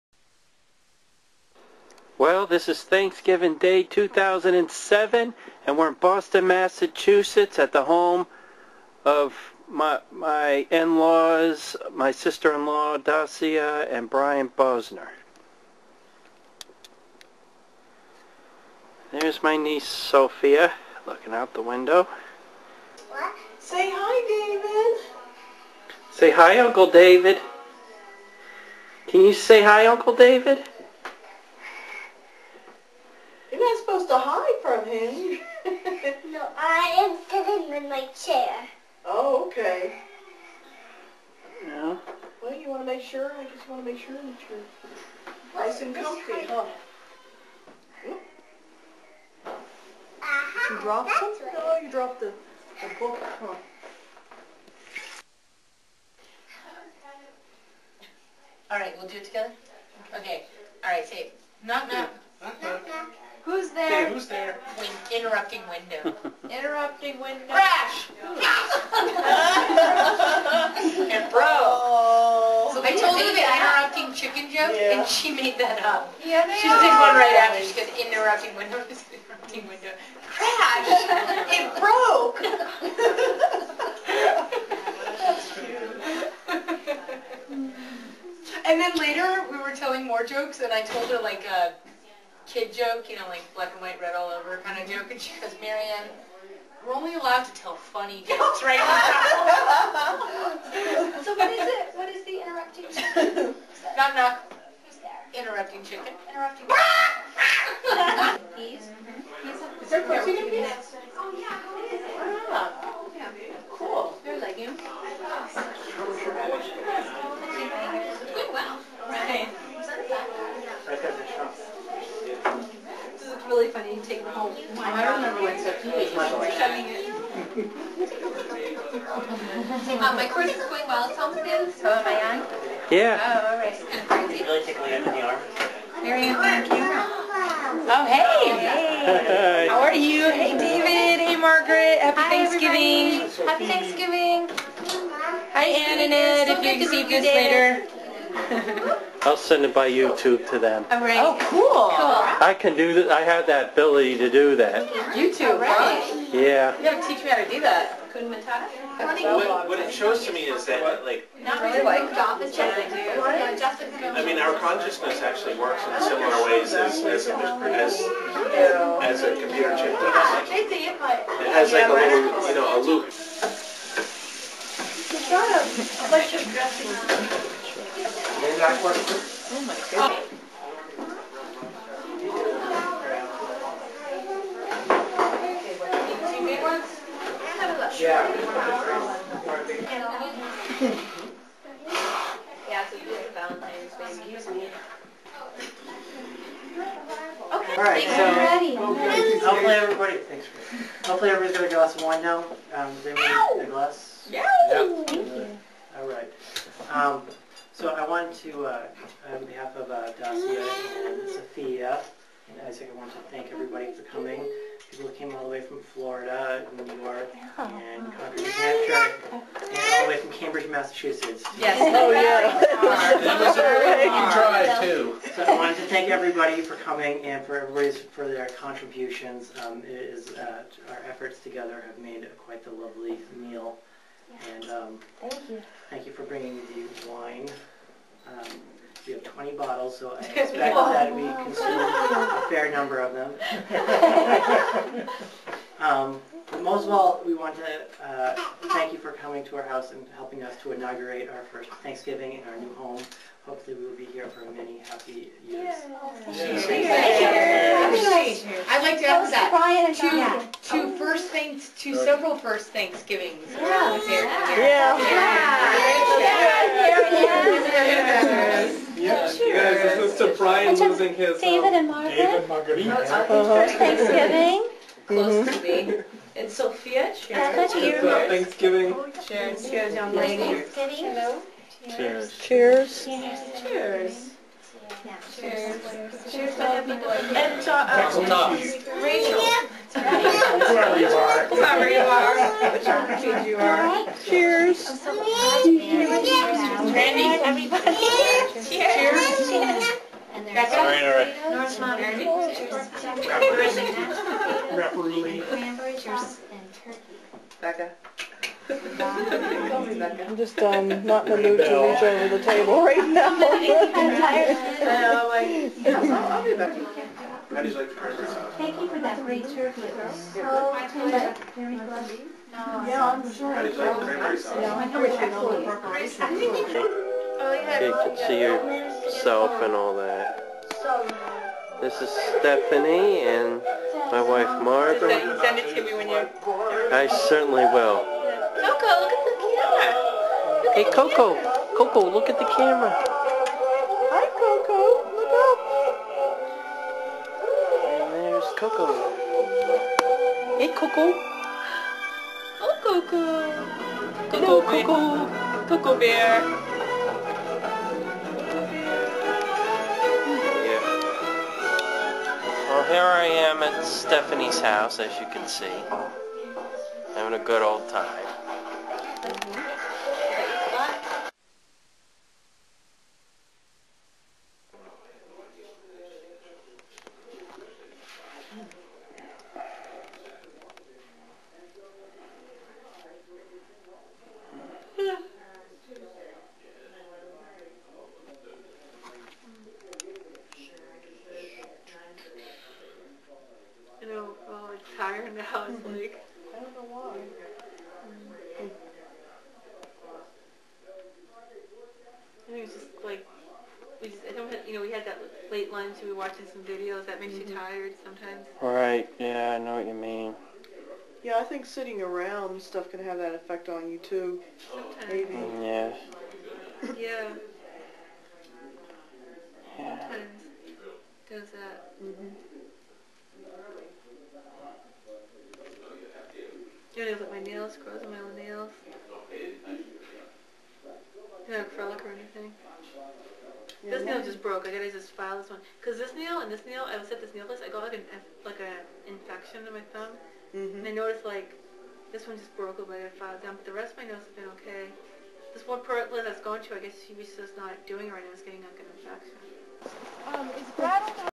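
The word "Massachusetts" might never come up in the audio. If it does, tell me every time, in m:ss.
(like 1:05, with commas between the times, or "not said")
0:06, 3:40.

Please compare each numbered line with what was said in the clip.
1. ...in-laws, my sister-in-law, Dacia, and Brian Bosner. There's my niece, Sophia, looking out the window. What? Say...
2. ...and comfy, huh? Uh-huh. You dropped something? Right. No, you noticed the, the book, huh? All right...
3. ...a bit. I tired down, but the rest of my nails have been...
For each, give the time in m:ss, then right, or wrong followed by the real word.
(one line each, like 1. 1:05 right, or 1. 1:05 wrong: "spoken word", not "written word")
1. 0:10 right
2. 0:45 wrong: "dropped", not "noticed"
3. 7:22 wrong: "filed", not "tired".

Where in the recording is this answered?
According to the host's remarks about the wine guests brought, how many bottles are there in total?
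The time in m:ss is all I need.
3:59.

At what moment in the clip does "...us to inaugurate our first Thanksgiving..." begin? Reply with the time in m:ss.
4:10.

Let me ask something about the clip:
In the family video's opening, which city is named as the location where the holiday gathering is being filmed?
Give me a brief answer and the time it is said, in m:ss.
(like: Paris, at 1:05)
Boston, at 0:05.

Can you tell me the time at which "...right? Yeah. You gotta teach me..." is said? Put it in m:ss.
2:35.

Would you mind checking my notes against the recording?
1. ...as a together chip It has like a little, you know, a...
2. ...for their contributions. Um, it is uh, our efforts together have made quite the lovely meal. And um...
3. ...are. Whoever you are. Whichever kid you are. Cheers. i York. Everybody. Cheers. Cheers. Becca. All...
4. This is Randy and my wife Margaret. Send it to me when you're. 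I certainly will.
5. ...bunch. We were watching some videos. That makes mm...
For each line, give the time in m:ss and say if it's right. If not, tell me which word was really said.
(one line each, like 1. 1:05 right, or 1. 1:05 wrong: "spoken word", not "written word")
1. 2:49 wrong: "computer", not "together"
2. 3:48 right
3. 4:51 wrong: "Randy", not "York"
4. 5:31 wrong: "Stephanie", not "Randy"
5. 6:45 wrong: "lunch", not "bunch".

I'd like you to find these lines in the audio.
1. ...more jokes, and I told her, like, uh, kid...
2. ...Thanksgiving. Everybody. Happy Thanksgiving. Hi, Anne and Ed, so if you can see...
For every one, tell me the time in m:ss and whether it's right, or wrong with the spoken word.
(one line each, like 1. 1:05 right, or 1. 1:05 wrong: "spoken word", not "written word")
1. 1:30 right
2. 2:22 right.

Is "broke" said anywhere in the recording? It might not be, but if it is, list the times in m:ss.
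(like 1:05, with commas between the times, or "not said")
1:21, 7:14, 7:22.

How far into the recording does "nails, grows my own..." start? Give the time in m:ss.
7:07.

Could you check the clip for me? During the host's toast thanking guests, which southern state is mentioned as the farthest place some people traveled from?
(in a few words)
Florida.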